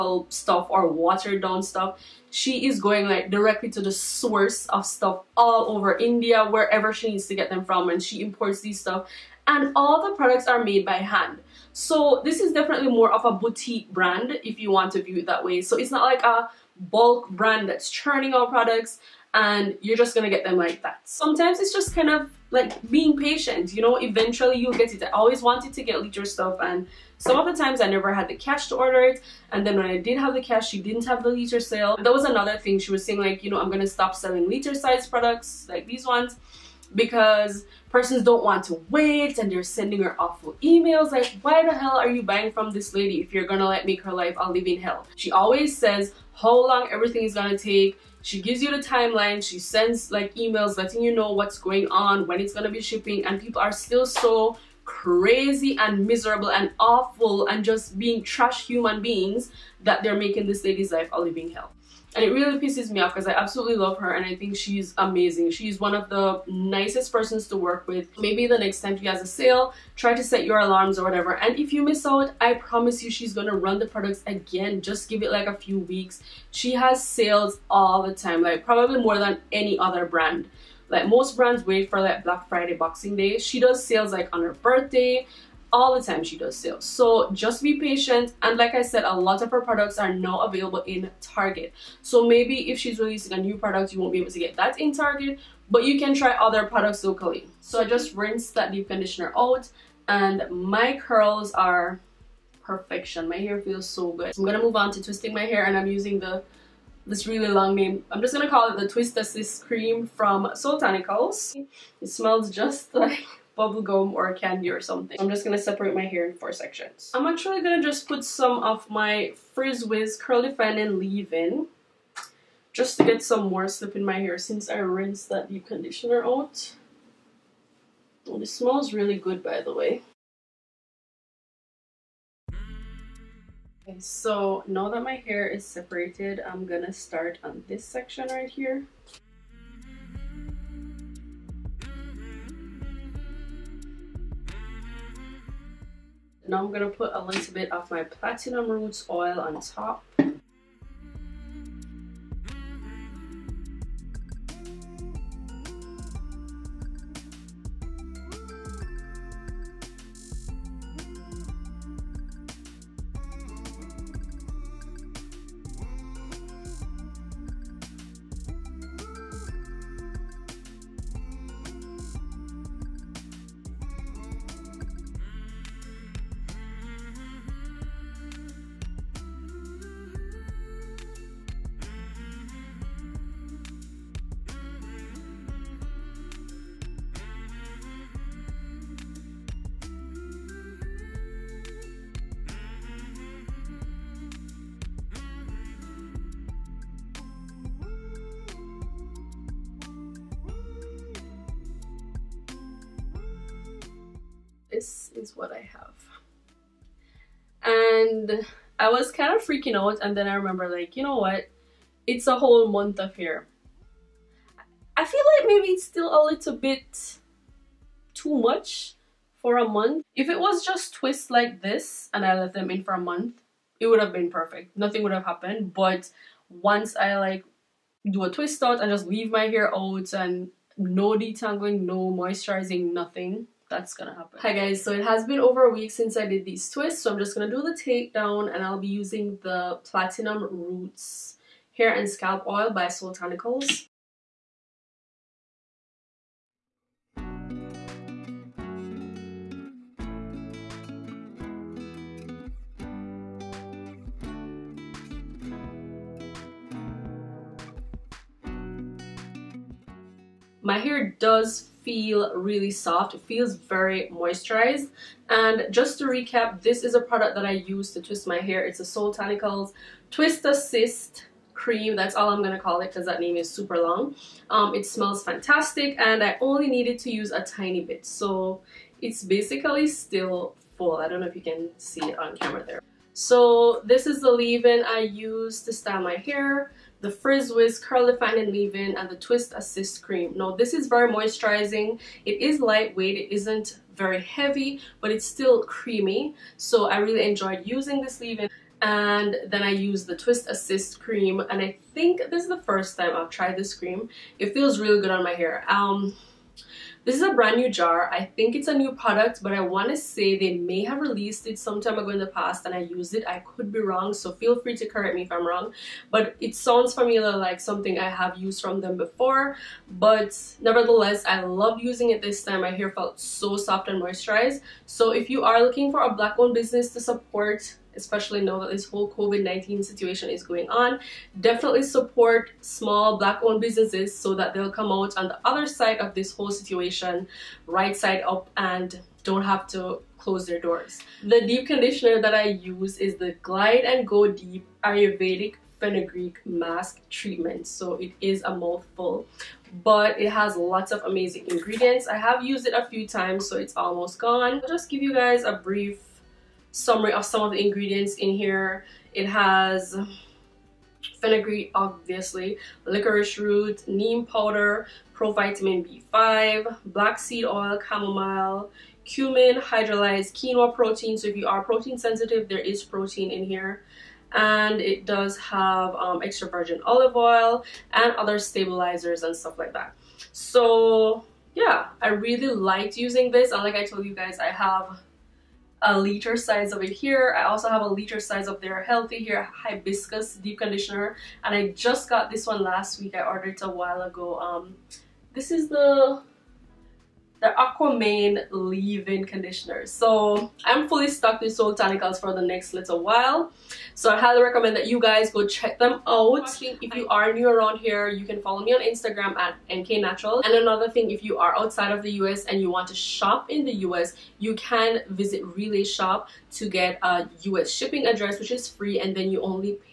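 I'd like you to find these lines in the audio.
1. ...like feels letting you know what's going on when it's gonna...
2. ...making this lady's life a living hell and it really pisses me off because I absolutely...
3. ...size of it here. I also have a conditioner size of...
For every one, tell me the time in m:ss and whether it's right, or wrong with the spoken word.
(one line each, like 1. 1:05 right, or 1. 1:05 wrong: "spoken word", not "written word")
1. 0:50 wrong: "emails", not "feels"
2. 1:00 right
3. 6:26 wrong: "liter", not "conditioner".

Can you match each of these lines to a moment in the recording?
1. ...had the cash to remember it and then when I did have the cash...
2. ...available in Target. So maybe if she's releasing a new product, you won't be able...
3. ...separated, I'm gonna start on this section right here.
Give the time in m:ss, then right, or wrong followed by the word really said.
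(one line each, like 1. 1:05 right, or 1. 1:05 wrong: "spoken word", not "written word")
1. 0:28 wrong: "order", not "remember"
2. 1:30 right
3. 2:15 right.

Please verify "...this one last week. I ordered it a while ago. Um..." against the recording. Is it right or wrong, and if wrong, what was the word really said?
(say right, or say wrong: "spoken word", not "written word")
right.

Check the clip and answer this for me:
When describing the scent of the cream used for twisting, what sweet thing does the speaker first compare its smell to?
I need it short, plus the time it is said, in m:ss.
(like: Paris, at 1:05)
bubble gum, at 1:53.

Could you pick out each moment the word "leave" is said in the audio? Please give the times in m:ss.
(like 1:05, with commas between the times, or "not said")
2:00, 3:49, 4:44, 4:48, 4:58, 6:38.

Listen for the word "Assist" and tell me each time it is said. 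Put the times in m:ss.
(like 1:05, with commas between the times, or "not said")
1:49, 4:30, 4:49, 5:00.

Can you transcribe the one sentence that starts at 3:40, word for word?
If it was just twists like this and I left them in for a month, it would have been perfect.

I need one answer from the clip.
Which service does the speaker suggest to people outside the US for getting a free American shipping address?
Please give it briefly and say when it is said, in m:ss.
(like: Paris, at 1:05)
Relay Shop, at 6:55.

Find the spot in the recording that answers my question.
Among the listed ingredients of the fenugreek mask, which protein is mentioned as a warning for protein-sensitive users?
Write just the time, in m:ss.
6:09.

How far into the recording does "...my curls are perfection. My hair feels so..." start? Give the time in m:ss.
1:40.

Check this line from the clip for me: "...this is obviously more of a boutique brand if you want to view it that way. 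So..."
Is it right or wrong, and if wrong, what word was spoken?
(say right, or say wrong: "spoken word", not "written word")
wrong: "definitely", not "obviously".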